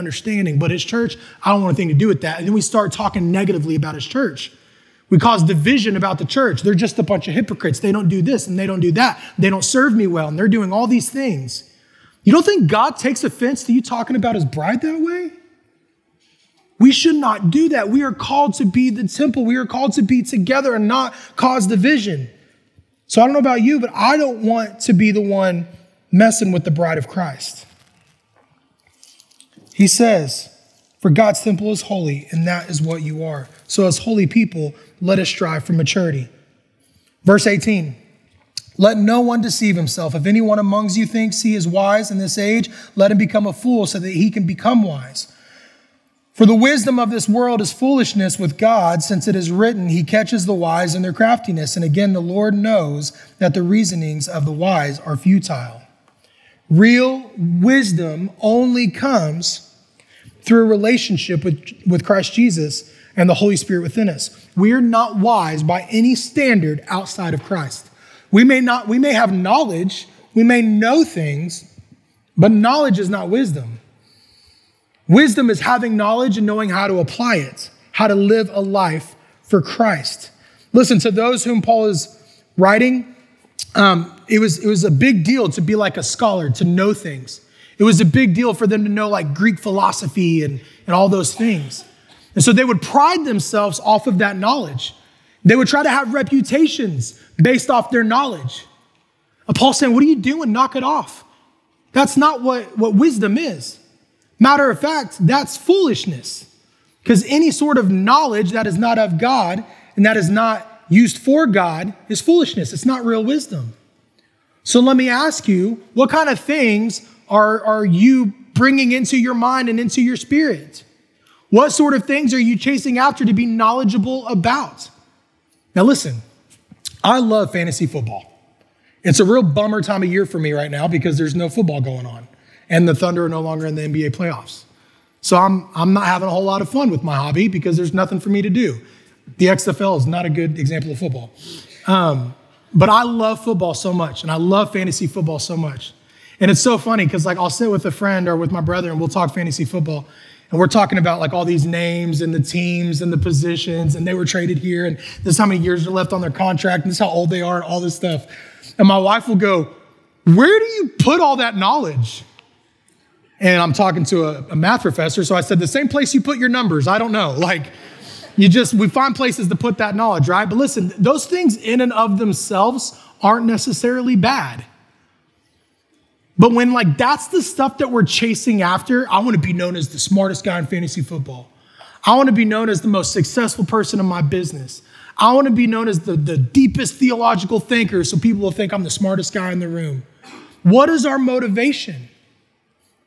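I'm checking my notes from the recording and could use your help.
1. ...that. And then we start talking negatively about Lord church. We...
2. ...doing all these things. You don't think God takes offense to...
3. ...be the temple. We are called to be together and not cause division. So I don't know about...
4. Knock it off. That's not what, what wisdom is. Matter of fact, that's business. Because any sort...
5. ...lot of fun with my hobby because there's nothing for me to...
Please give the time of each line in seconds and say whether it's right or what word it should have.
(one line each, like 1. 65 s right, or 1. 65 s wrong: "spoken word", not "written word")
1. 2 s wrong: "His", not "Lord"
2. 10 s right
3. 18 s right
4. 100 s wrong: "foolishness", not "business"
5. 136 s right.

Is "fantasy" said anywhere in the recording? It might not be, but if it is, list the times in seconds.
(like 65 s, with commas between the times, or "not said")
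127 s, 144 s, 149 s, 180 s.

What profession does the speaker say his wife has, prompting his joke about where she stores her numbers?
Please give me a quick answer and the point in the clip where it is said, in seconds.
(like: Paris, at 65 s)
Math professor, at 164 s.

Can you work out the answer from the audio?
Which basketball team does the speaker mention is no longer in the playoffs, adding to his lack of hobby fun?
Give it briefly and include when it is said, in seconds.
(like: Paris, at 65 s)
Thunder, at 132 s.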